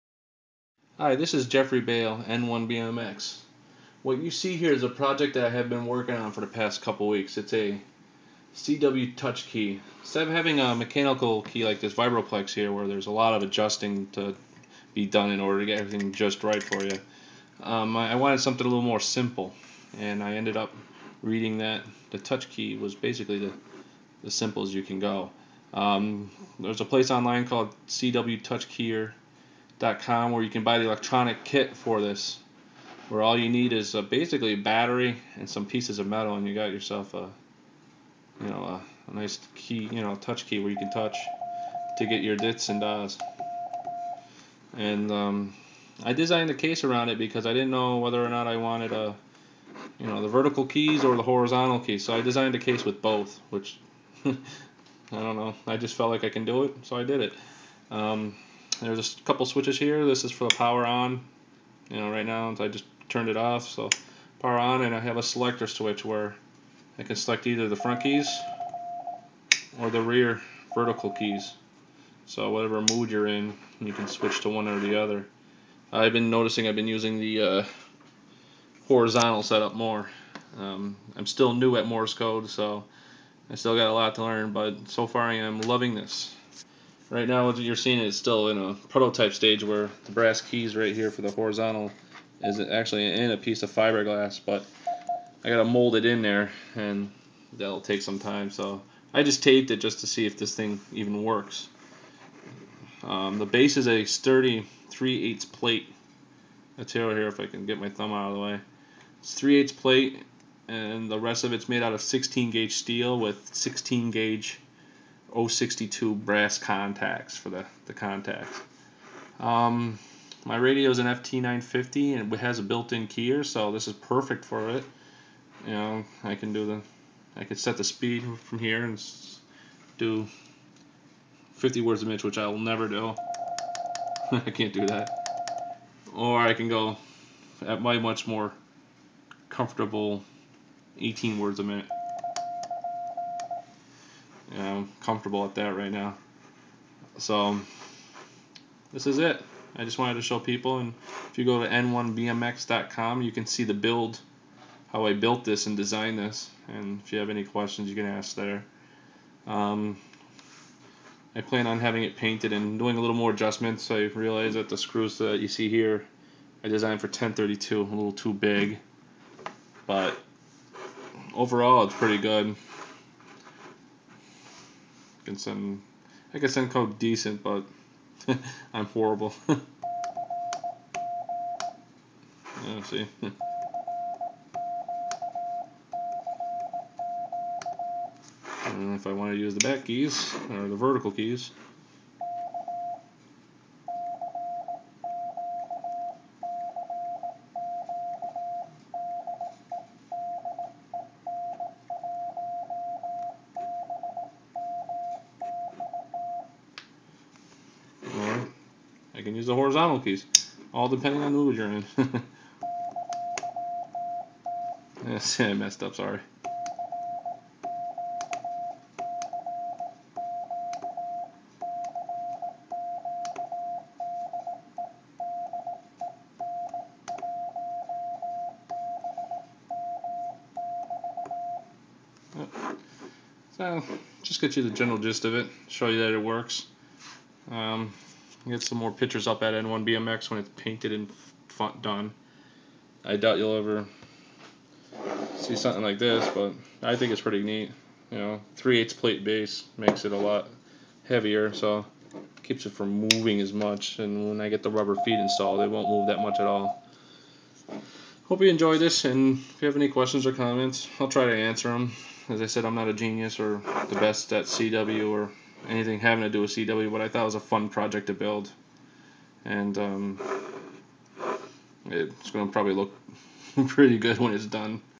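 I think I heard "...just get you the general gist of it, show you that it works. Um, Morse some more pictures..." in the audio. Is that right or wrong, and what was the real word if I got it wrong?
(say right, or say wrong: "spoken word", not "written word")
wrong: "Get", not "Morse".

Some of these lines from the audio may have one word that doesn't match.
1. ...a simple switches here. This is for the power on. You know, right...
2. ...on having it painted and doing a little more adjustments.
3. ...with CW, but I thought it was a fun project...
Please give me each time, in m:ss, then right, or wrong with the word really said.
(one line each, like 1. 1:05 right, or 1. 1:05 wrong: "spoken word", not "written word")
1. 0:59 wrong: "couple", not "simple"
2. 2:41 right
3. 4:26 right.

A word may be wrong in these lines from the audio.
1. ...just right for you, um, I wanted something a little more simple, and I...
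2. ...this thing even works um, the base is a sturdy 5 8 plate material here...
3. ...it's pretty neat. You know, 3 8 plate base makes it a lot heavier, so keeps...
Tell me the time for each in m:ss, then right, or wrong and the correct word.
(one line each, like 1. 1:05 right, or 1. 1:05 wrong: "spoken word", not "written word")
1. 0:16 right
2. 1:40 wrong: "3", not "5"
3. 4:07 right.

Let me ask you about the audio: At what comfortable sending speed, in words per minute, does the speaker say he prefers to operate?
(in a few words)
18.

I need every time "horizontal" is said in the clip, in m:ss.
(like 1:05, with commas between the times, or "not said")
0:51, 1:18, 1:31, 3:29.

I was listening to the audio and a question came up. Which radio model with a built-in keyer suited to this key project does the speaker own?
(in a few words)
FT950.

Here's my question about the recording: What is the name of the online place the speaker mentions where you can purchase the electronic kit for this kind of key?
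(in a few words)
CW Touch Keyer com.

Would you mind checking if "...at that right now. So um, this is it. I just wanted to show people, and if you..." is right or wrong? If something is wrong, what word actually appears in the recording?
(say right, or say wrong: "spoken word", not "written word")
right.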